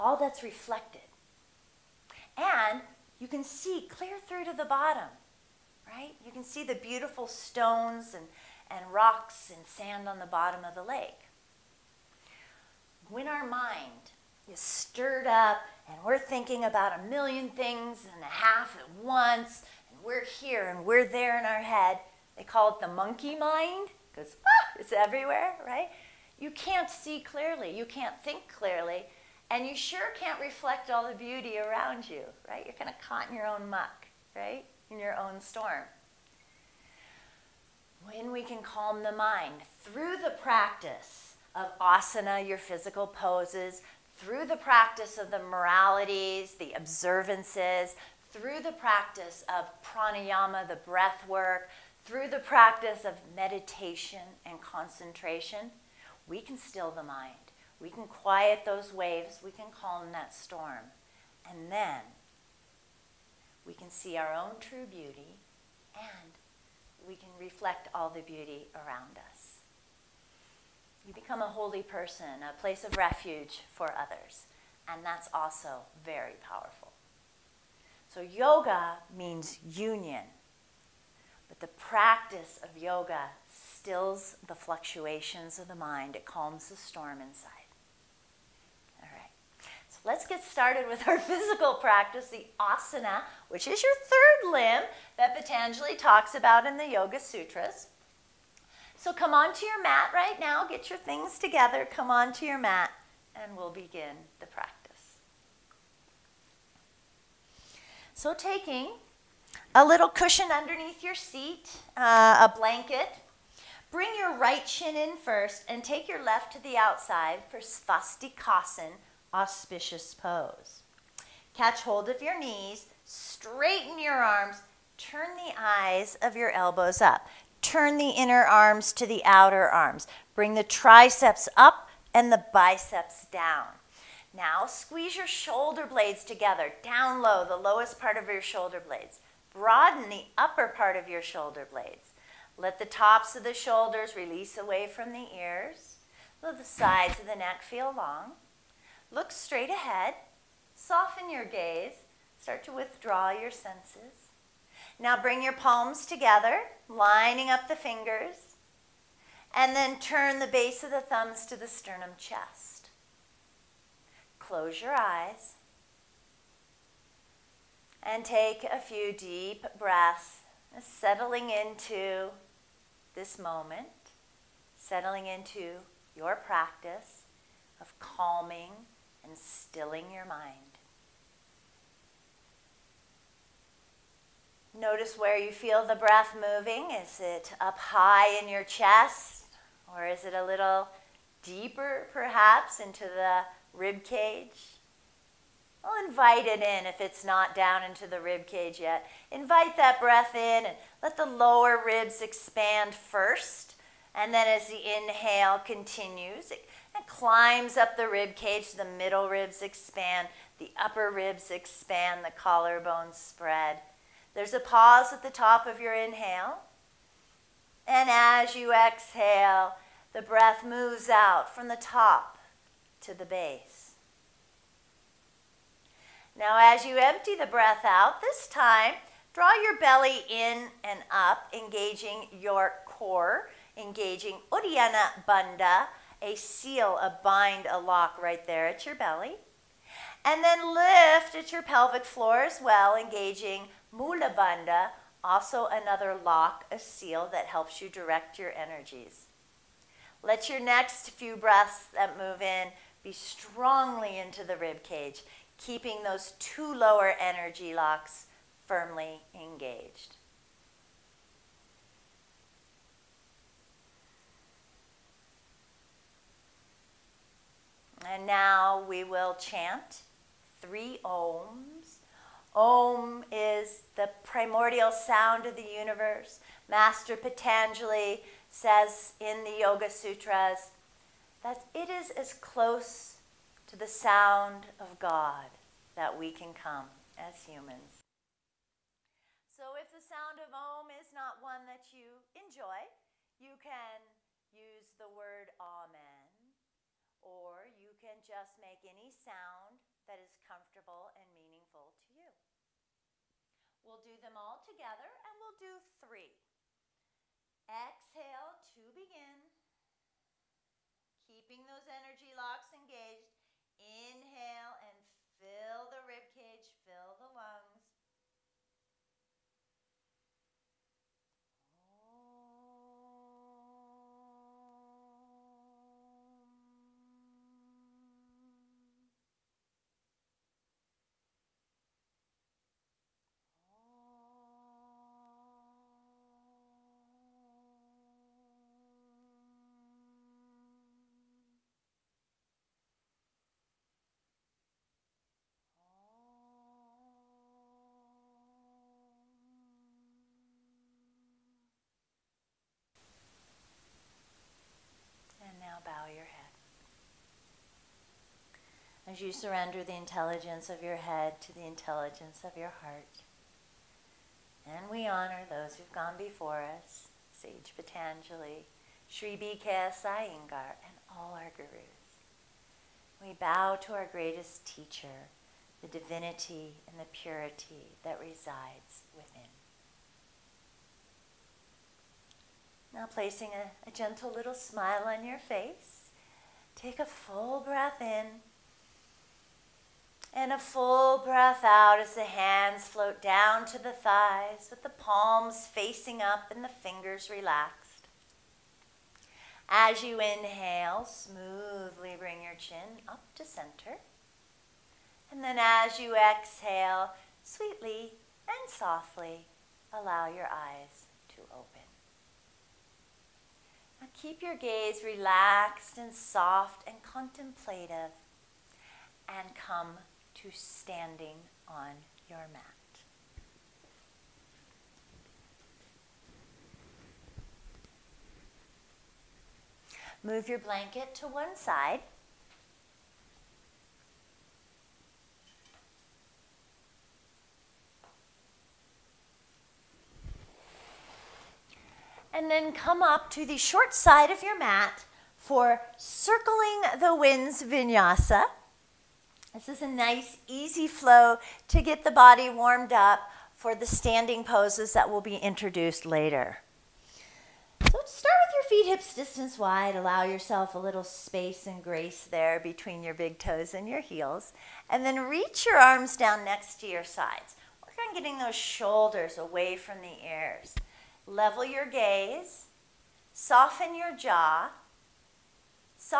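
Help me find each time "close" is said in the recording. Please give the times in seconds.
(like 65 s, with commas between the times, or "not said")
164 s, 282 s.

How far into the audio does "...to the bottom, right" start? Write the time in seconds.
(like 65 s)
4 s.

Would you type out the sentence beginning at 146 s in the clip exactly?
Let the sides of the neck feel long.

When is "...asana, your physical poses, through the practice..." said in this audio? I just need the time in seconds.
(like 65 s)
41 s.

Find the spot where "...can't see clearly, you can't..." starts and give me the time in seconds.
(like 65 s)
26 s.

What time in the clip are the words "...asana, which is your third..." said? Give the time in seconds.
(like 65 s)
92 s.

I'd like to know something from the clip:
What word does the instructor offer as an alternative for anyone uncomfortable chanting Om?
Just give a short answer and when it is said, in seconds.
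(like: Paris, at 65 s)
Amen, at 295 s.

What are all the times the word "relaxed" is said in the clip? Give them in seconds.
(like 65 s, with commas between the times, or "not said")
397 s, 415 s.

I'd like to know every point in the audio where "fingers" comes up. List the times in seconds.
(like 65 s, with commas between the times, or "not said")
157 s, 396 s.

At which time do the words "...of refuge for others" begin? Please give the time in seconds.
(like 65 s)
72 s.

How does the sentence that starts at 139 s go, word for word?
Broaden the upper part of your shoulder blades.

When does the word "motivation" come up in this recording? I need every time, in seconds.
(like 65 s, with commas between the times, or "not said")
not said.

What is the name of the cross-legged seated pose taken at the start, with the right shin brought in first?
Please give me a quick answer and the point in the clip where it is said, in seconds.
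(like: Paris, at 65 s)
Svastikasan, at 117 s.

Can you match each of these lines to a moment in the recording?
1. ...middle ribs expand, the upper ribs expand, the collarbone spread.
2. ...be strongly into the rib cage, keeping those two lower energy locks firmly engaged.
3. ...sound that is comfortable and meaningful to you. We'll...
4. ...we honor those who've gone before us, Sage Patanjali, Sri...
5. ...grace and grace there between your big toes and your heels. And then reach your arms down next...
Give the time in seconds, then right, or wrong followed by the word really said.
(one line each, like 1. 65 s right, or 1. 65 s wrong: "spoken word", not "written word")
1. 208 s right
2. 253 s right
3. 299 s right
4. 364 s right
5. 461 s wrong: "space", not "grace".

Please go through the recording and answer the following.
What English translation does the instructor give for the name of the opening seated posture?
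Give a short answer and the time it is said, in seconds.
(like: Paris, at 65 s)
auspicious pose, at 119 s.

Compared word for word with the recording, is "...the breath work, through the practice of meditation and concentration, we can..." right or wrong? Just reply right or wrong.
right.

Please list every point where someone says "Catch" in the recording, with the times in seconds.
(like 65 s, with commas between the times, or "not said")
121 s.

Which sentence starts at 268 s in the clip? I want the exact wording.
And now we will chant three ohms Om is the primordial sound of the universe.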